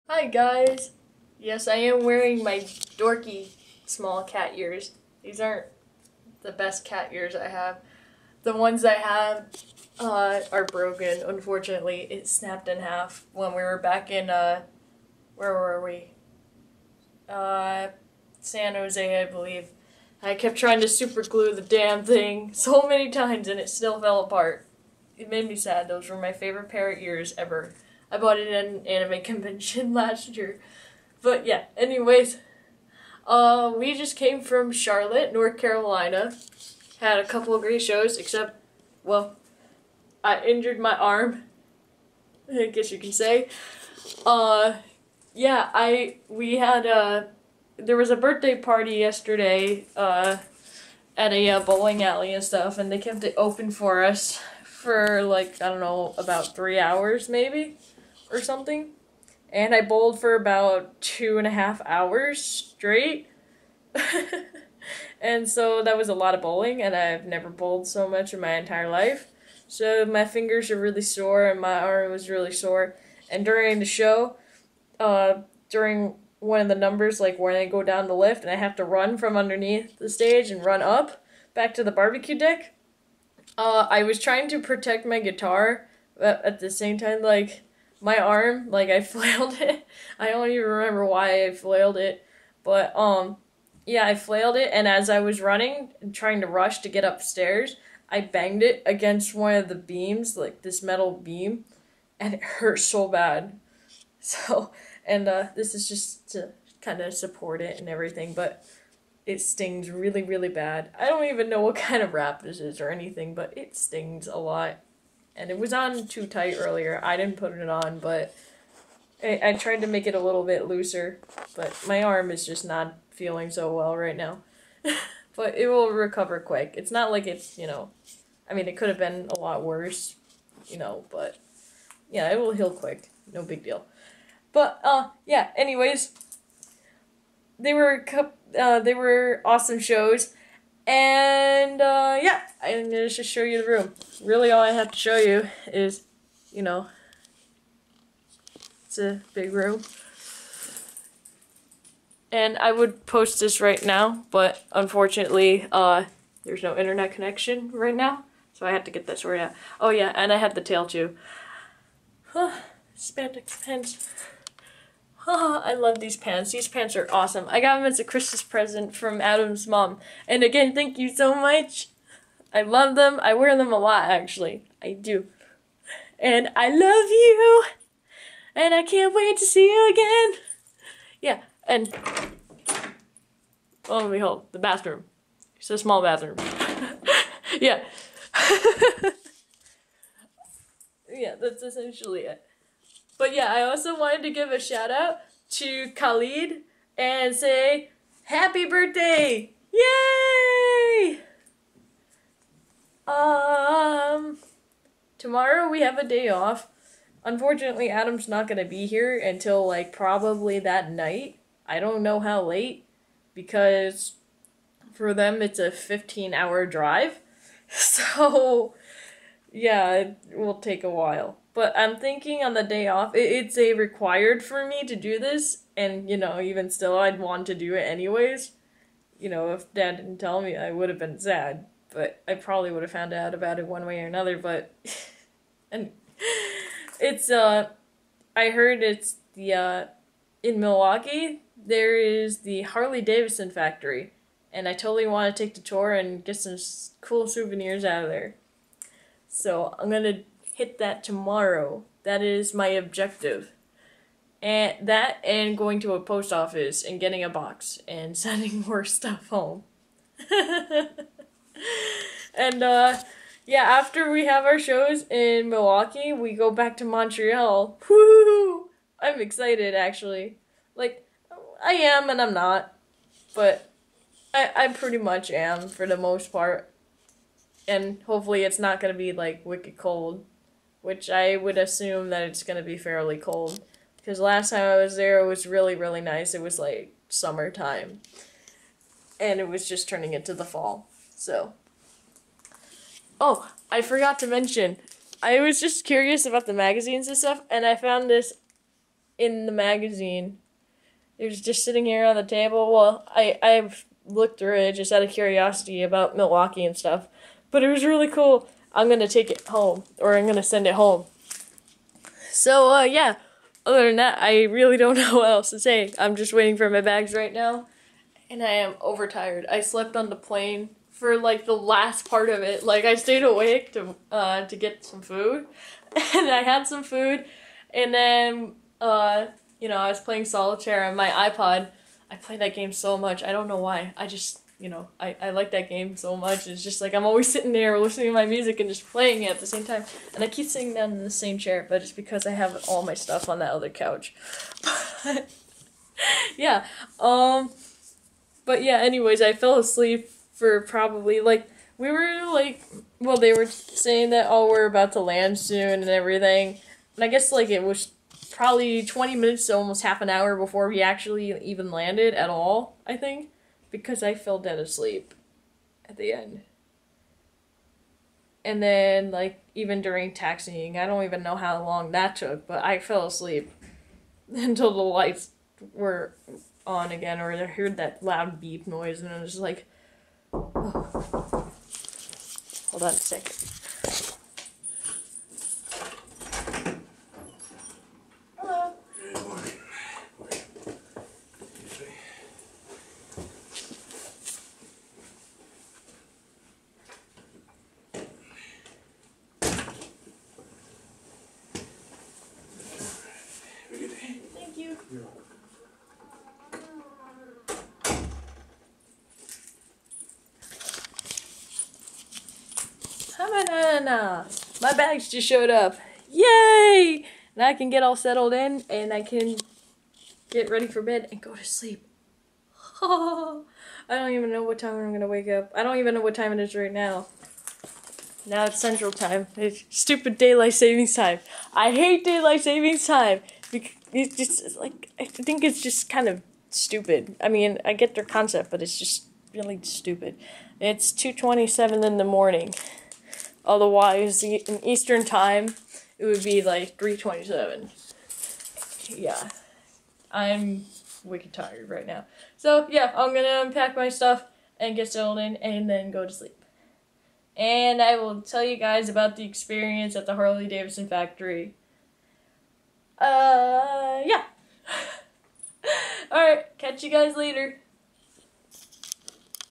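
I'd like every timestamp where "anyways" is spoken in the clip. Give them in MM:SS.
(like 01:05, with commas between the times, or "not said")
00:31, 02:15, 03:47, 05:48.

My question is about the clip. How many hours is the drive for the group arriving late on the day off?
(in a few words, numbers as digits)
15.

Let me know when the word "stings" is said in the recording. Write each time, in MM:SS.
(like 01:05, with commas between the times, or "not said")
01:49, 01:53.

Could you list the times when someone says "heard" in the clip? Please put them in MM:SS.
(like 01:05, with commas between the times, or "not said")
03:58, 06:17.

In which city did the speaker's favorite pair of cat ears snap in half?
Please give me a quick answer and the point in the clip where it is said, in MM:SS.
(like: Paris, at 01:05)
San Jose, at 00:18.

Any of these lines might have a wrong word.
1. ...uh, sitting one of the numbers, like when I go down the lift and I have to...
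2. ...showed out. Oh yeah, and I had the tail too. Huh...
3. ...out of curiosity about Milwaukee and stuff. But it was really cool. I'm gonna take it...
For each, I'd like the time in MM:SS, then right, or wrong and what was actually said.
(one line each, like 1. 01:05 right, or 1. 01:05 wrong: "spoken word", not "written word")
1. 01:14 wrong: "during", not "sitting"
2. 02:39 wrong: "sorted", not "showed"
3. 05:04 right.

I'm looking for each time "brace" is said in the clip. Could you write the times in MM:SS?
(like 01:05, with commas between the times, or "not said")
not said.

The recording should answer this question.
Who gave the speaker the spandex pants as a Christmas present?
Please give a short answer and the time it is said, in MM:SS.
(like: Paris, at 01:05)
Adam's mom, at 02:49.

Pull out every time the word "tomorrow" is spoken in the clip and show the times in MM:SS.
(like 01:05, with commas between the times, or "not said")
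03:25, 04:11.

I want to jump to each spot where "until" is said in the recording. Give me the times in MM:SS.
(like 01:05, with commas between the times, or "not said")
03:29, 06:14.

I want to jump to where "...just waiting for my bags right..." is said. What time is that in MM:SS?
05:16.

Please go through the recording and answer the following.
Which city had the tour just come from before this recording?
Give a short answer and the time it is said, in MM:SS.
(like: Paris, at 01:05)
Charlotte, North Carolina, at 00:34.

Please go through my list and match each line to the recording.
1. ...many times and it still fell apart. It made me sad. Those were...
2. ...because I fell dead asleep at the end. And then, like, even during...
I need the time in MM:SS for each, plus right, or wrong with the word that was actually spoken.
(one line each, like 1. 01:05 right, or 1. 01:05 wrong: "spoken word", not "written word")
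1. 00:22 right
2. 06:03 right.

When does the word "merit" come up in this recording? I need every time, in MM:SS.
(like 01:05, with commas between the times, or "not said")
not said.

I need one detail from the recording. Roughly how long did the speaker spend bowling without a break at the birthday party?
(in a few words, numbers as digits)
2.5 hours.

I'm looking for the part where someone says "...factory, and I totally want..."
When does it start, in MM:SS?
04:03.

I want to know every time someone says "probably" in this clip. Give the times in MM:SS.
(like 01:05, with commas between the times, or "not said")
03:29, 03:52, 05:50, 05:58.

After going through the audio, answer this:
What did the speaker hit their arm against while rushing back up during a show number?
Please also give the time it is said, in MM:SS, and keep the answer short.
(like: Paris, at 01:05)
metal beam, at 01:40.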